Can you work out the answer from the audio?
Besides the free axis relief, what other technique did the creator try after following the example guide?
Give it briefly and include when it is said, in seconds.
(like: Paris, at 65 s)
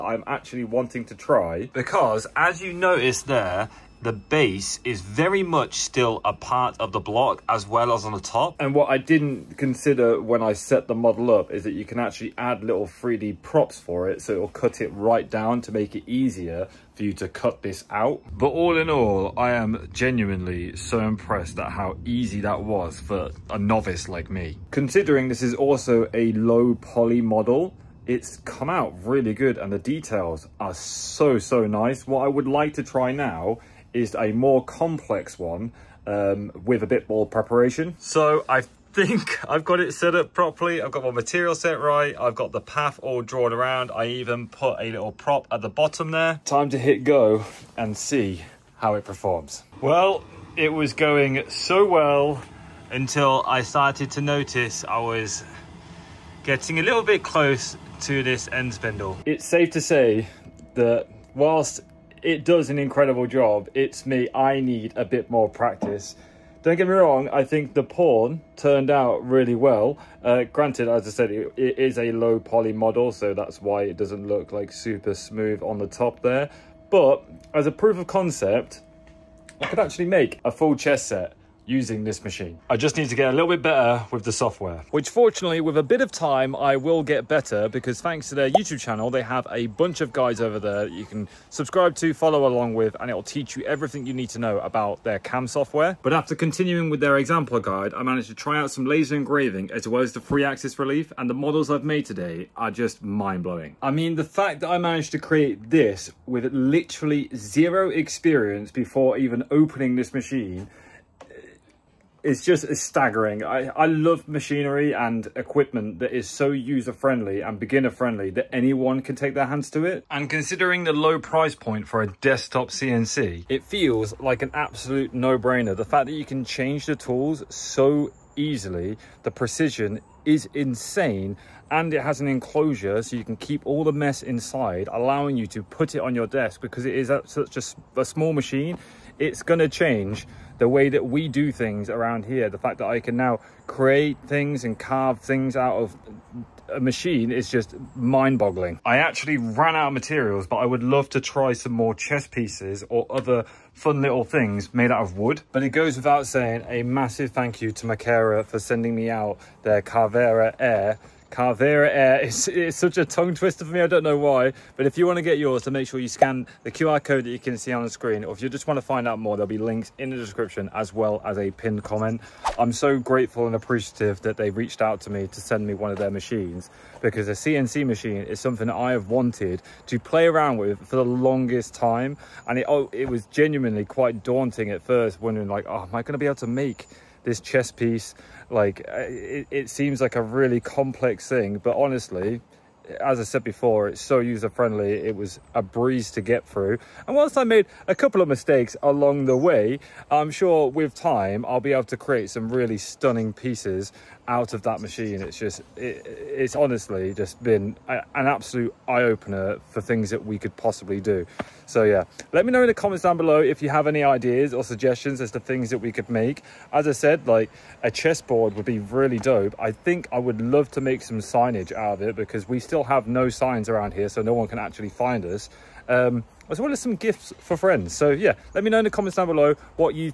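Laser engraving, at 98 s.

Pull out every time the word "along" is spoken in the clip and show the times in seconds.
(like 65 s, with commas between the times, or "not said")
92 s, 198 s.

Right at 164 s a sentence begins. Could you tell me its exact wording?
But if you want to get yours, then make sure you scan the QR code that you can see on the screen.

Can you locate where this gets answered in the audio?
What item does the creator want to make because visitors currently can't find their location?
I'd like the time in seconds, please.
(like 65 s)
221 s.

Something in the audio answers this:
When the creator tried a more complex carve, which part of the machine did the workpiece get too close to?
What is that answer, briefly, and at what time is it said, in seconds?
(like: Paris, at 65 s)
End spindle, at 58 s.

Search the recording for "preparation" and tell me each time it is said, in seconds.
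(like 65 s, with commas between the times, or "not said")
37 s.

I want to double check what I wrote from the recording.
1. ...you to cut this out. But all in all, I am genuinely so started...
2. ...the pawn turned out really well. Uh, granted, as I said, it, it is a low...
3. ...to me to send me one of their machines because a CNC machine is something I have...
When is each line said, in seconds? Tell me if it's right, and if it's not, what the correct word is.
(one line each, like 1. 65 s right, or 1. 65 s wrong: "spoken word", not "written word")
1. 17 s wrong: "impressed", not "started"
2. 67 s right
3. 175 s right.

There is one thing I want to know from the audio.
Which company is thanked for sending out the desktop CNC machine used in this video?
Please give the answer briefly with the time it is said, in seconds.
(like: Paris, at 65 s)
Makera, at 157 s.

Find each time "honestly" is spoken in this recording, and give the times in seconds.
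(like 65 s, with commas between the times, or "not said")
191 s, 206 s.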